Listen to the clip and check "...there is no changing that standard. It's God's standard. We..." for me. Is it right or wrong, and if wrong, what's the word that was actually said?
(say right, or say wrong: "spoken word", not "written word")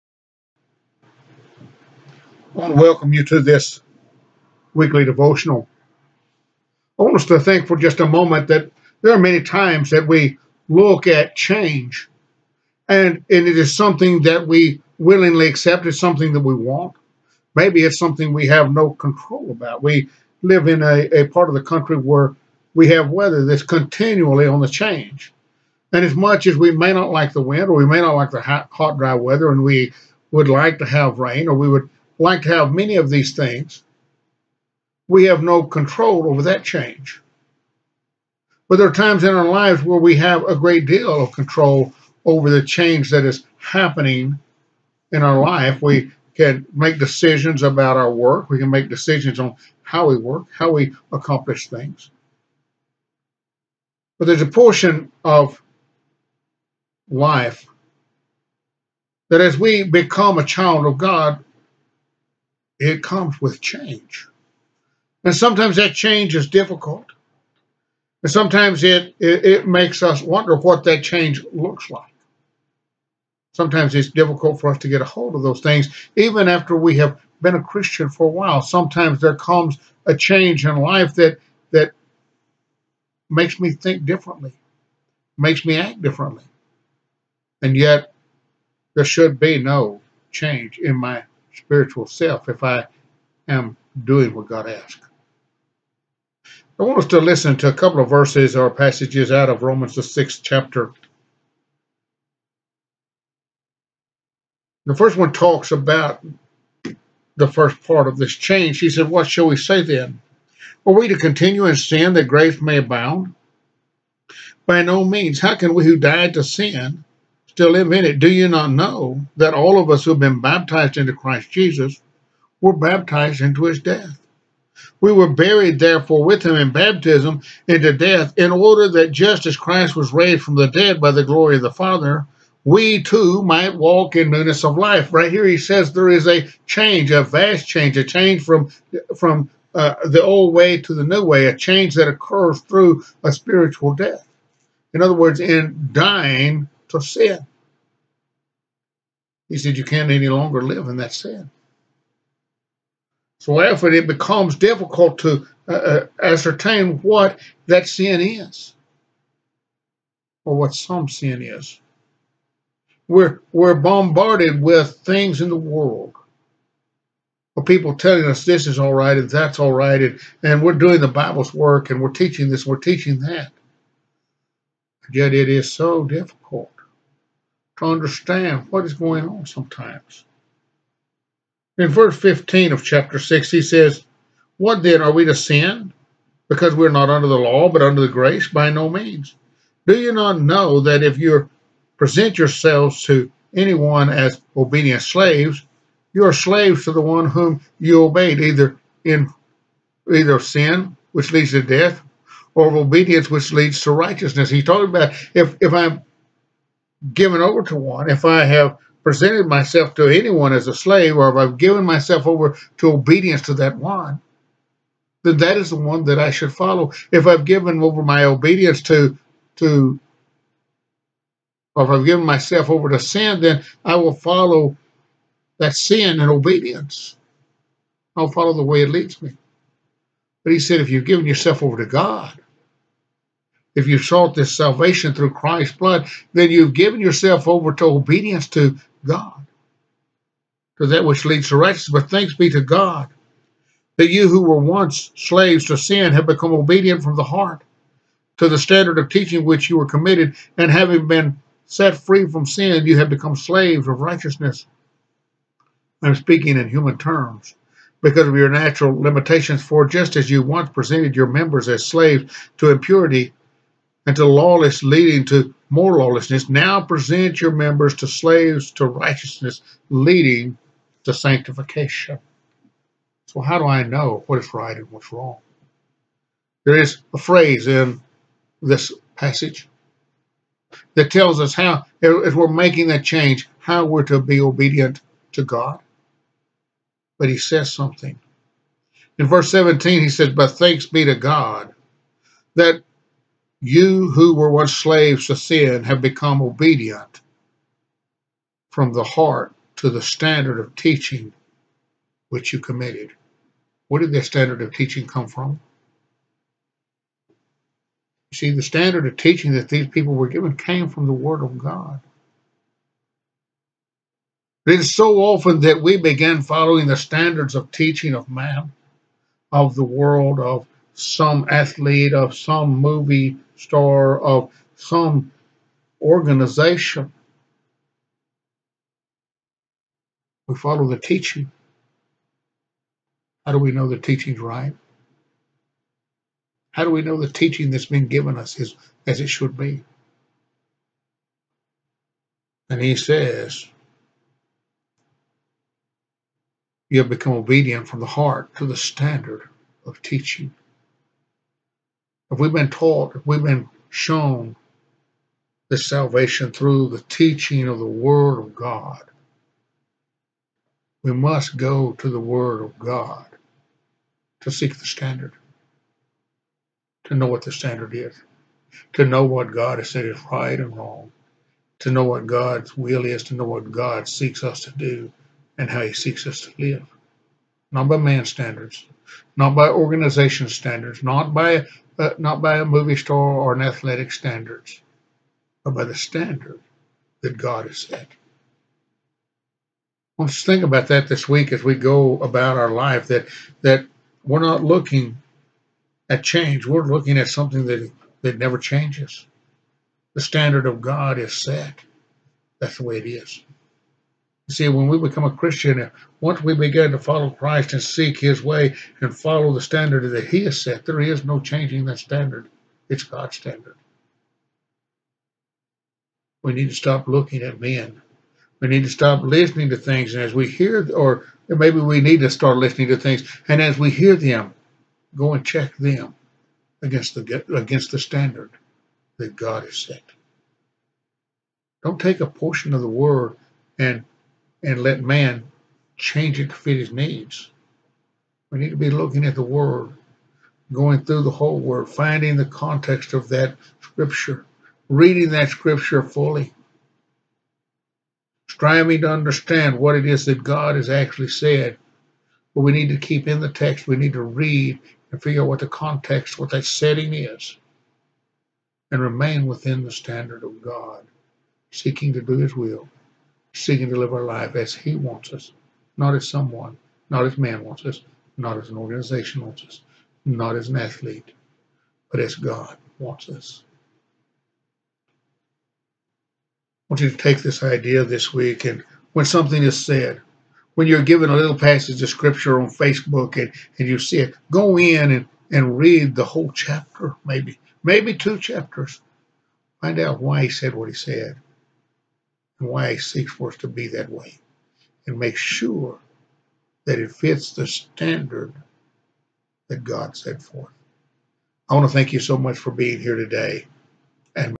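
right.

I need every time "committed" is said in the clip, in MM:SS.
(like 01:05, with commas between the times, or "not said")
04:09, 05:02.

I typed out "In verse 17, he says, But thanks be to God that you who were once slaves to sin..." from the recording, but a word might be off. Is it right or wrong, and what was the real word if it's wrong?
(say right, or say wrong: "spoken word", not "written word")
right.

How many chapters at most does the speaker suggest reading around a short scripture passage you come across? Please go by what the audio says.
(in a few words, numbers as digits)
2.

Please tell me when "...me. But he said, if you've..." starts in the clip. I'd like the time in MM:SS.
03:49.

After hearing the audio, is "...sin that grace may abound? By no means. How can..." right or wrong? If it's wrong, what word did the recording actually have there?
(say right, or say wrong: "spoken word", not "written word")
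right.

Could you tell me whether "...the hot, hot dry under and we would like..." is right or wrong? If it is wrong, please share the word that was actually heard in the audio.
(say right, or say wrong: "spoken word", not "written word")
wrong: "weather", not "under".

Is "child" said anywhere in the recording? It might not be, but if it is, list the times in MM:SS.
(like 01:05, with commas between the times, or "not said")
01:00.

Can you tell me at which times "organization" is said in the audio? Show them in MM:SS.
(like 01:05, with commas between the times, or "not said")
05:26, 06:19, 07:48.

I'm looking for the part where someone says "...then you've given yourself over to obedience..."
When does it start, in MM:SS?
03:56.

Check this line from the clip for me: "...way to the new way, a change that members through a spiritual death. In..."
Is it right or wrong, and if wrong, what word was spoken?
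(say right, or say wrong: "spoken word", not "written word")
wrong: "occurs", not "members".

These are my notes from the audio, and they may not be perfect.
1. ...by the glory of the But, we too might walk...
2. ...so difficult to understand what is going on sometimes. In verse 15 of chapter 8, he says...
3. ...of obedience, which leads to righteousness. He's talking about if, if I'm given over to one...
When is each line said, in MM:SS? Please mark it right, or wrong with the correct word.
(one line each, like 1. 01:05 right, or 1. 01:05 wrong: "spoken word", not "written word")
1. 02:11 wrong: "Father", not "But"
2. 02:55 wrong: "6", not "8"
3. 03:22 right.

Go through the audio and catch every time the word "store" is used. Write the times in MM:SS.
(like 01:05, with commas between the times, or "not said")
06:22.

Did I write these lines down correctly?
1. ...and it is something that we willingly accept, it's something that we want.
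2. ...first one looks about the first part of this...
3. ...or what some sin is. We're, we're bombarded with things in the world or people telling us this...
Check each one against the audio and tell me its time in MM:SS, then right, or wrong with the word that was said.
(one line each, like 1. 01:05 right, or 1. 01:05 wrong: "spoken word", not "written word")
1. 00:13 right
2. 01:44 wrong: "talks", not "looks"
3. 02:40 right.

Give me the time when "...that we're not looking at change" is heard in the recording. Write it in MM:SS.
06:33.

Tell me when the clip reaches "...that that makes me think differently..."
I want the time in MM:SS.
01:21.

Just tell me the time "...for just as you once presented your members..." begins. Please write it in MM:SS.
04:19.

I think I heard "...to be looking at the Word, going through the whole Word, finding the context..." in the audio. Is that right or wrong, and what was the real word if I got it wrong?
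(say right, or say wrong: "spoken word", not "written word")
right.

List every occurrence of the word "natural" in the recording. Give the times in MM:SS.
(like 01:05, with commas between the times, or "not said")
04:18.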